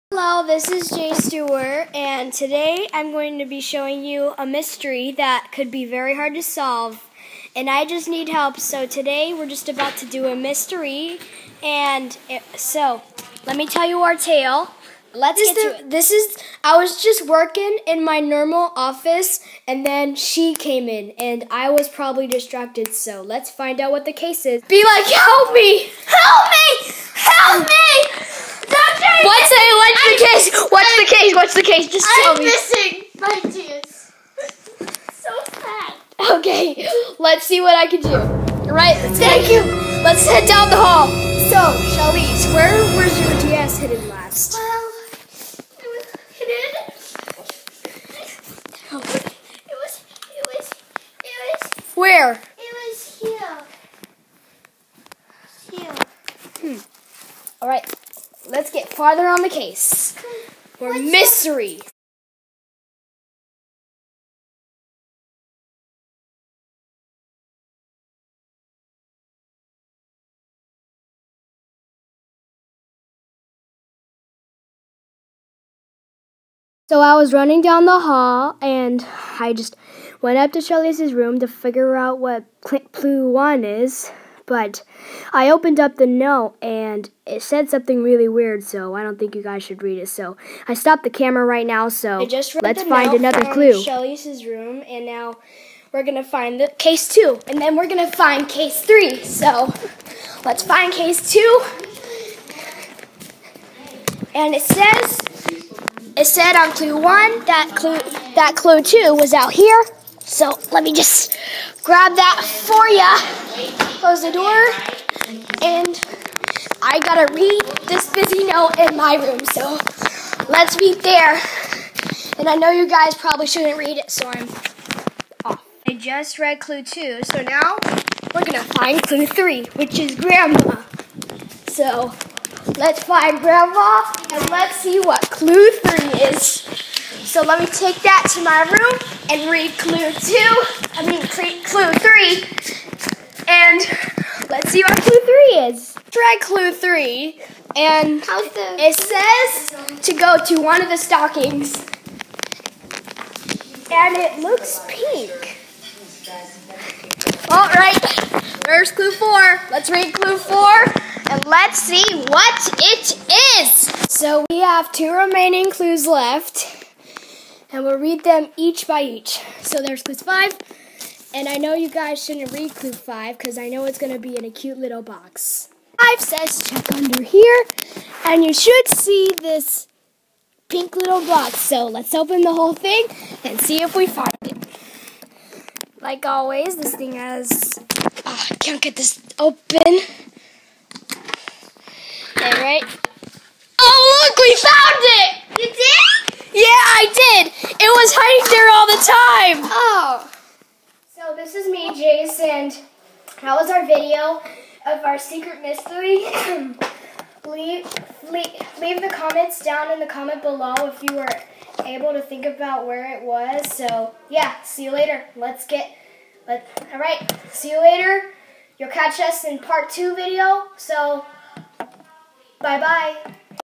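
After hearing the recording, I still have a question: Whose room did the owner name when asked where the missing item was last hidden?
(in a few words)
Charlize.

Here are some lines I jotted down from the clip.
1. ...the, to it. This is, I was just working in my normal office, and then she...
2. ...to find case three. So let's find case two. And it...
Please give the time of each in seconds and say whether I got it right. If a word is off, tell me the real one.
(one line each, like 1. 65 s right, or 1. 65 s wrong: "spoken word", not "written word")
1. 15 s right
2. 98 s right.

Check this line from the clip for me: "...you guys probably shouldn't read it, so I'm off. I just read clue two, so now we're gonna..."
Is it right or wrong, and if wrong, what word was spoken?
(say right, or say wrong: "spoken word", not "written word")
right.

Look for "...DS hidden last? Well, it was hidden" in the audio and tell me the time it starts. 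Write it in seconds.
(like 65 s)
43 s.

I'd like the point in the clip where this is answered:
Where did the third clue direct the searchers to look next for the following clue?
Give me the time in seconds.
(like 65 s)
150 s.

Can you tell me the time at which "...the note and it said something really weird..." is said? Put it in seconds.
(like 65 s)
85 s.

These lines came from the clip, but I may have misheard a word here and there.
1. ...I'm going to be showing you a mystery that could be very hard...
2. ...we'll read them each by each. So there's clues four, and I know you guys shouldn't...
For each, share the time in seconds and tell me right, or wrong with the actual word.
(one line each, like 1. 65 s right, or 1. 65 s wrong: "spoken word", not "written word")
1. 2 s right
2. 167 s wrong: "five", not "four".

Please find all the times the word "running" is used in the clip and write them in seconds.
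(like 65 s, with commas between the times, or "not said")
77 s.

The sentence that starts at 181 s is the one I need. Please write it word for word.
So let's open the whole thing and see if we find it.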